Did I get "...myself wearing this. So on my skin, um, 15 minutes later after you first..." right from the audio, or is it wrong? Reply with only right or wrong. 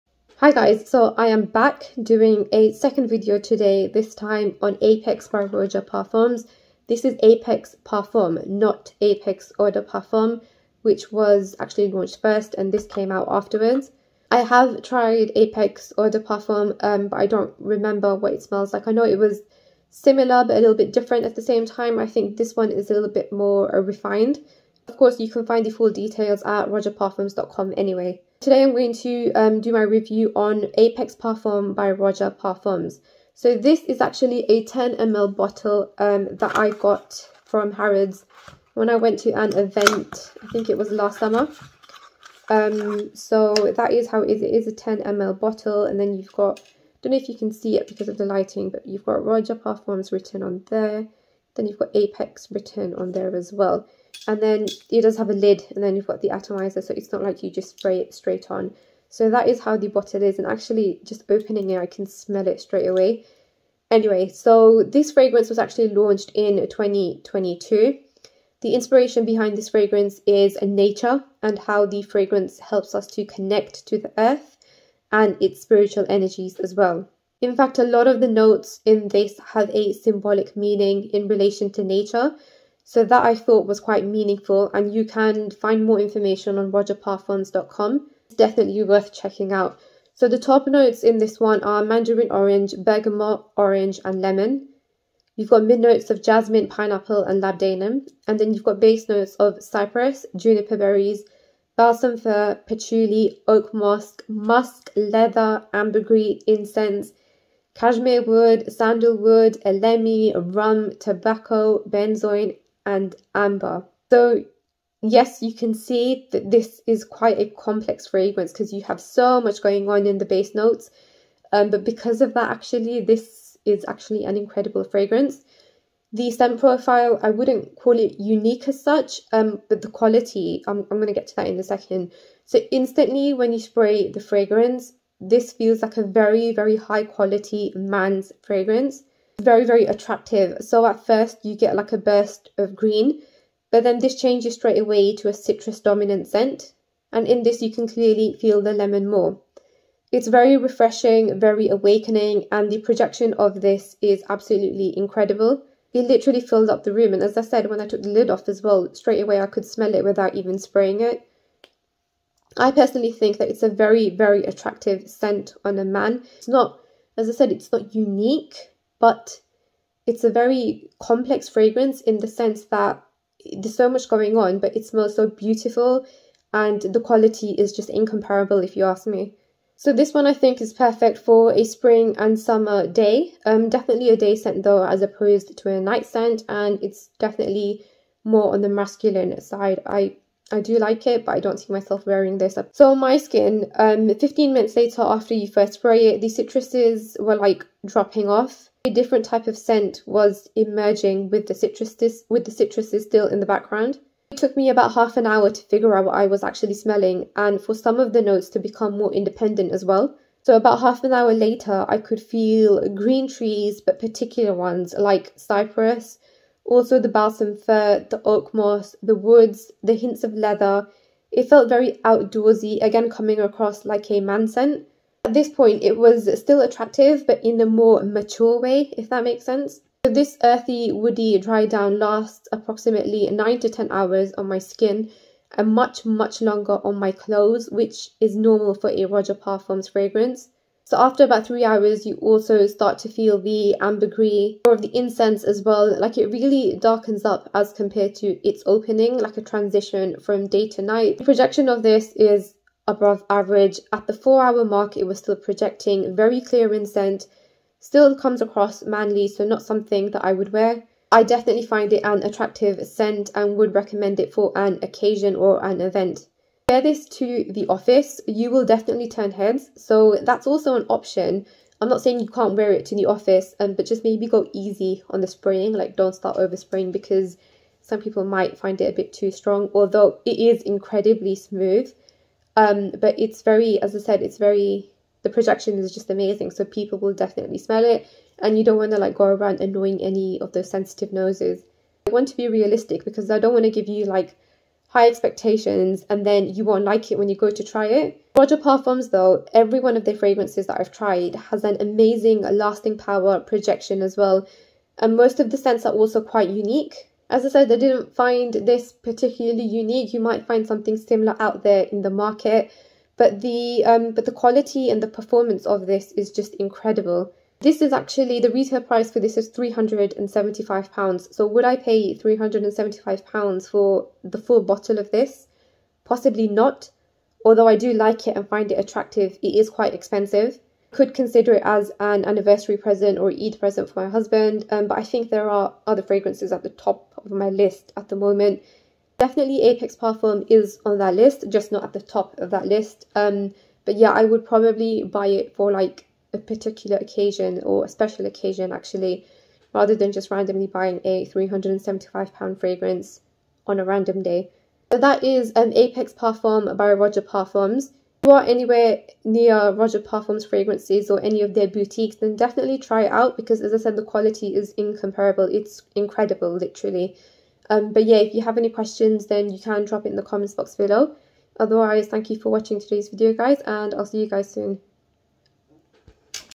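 right.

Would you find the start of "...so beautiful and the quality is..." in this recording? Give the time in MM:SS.
02:55.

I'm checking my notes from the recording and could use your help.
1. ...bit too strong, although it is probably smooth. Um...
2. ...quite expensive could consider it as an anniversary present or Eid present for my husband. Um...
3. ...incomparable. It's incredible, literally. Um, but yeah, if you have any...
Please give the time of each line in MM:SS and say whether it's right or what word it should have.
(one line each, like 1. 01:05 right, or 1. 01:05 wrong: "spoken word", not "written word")
1. 04:38 wrong: "incredibly", not "probably"
2. 05:29 right
3. 06:04 right.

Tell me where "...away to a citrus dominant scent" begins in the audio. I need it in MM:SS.
02:24.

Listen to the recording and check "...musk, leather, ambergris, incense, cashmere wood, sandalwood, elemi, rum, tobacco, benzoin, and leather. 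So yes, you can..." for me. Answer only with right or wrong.
wrong.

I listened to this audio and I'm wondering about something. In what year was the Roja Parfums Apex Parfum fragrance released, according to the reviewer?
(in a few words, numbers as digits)
2022.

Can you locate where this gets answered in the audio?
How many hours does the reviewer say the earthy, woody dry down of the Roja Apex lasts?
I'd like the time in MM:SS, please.
03:53.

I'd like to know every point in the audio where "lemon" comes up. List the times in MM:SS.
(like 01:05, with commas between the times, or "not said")
01:34, 02:28.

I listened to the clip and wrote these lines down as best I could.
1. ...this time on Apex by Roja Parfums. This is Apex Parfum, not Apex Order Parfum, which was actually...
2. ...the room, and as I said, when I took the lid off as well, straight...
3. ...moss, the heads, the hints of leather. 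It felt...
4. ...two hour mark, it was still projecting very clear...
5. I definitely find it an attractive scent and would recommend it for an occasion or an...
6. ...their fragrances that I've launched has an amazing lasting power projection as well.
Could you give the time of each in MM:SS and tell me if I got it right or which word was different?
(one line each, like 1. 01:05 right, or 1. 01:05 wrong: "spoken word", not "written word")
1. 00:03 right
2. 02:36 right
3. 03:38 wrong: "woods", not "heads"
4. 04:14 wrong: "four", not "two"
5. 04:21 right
6. 05:00 wrong: "tried", not "launched".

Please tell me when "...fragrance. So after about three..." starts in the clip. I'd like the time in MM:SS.
03:59.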